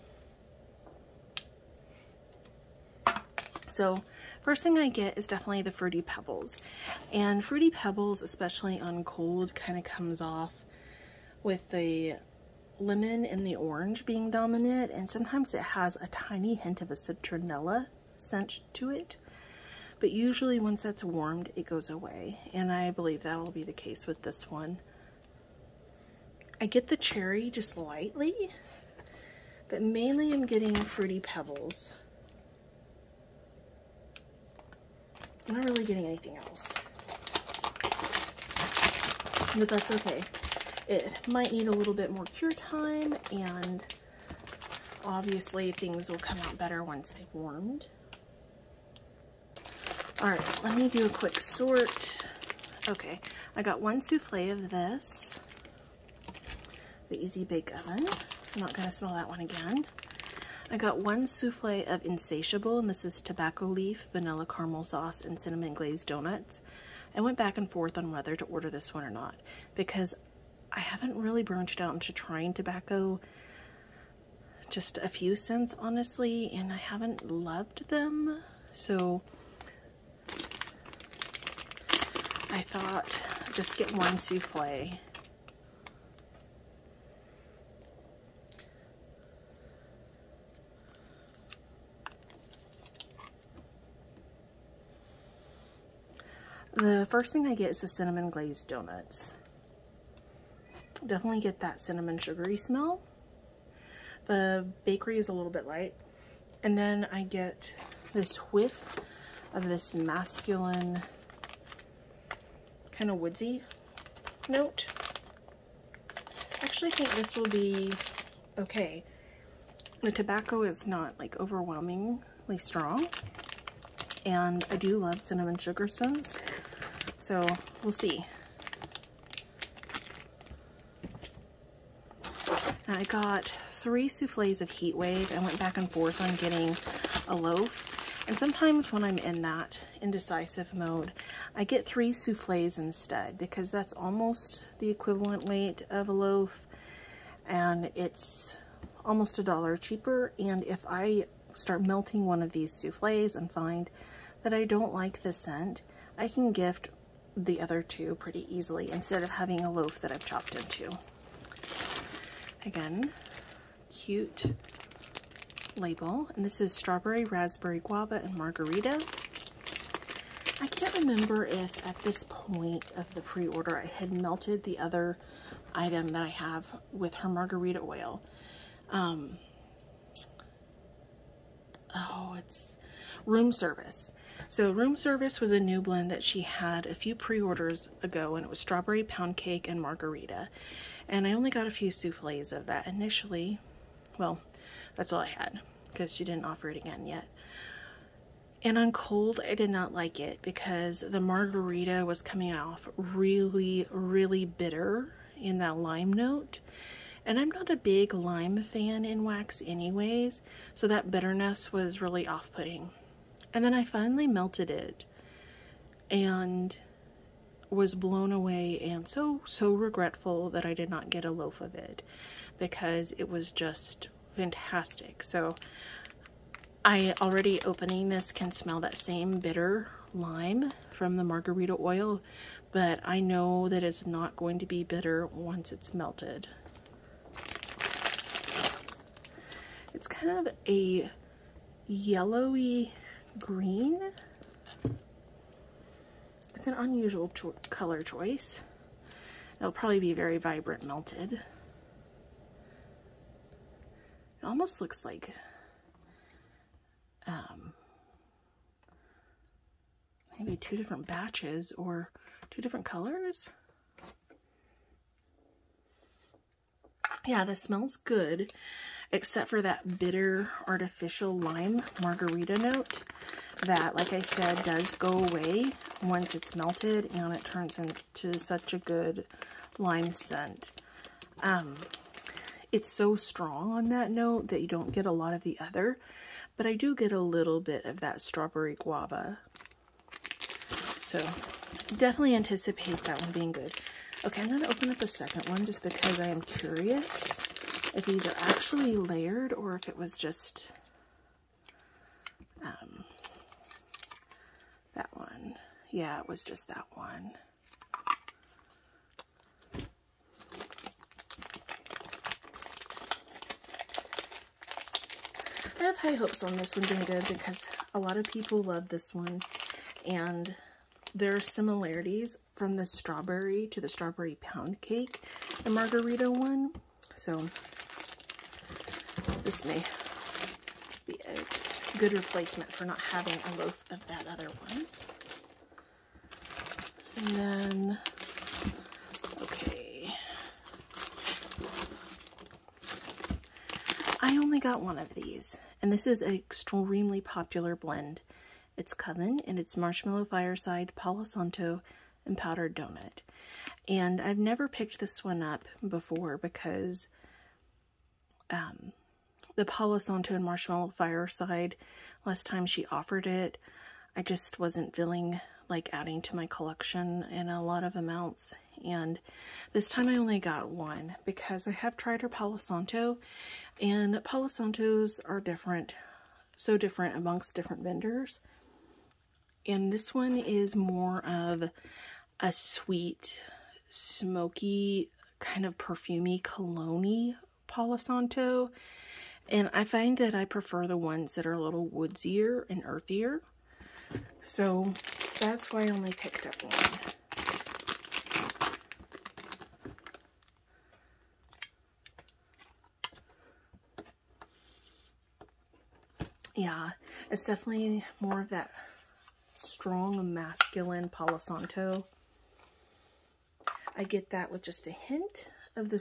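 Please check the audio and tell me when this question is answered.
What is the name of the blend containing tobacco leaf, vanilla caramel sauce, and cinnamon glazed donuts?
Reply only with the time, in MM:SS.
01:02.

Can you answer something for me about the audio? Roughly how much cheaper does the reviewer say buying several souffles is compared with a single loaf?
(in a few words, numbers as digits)
almost a dollar.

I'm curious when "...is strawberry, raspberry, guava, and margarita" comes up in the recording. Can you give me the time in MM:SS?
02:46.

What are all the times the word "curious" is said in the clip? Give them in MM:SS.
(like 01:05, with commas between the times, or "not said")
04:56.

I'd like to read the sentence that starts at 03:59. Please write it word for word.
It's kind of a yellowy green.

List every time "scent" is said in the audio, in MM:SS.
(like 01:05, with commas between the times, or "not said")
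00:18, 02:05, 02:35, 04:40.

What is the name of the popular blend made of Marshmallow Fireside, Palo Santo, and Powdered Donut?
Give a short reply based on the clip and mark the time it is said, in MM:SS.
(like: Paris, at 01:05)
Coven, at 05:48.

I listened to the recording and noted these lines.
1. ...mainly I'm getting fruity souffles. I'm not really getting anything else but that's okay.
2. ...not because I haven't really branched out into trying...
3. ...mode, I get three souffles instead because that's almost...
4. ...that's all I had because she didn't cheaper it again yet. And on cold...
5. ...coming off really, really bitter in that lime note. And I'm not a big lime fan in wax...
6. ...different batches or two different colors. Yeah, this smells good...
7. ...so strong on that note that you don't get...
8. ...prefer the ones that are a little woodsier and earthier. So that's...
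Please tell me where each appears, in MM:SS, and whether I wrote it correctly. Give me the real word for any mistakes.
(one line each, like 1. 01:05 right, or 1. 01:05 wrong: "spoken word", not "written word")
1. 00:29 wrong: "pebbles", not "souffles"
2. 01:09 right
3. 02:20 right
4. 03:14 wrong: "offer", not "cheaper"
5. 03:22 right
6. 04:20 right
7. 04:42 right
8. 06:30 right.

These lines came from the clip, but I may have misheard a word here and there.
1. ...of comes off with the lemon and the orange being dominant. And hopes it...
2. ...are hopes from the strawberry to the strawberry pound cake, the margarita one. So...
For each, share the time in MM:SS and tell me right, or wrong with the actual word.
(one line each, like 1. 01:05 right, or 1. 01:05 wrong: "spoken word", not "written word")
1. 00:09 wrong: "sometimes", not "hopes"
2. 05:21 wrong: "similarities", not "hopes".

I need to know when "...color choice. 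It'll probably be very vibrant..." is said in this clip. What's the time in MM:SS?
04:07.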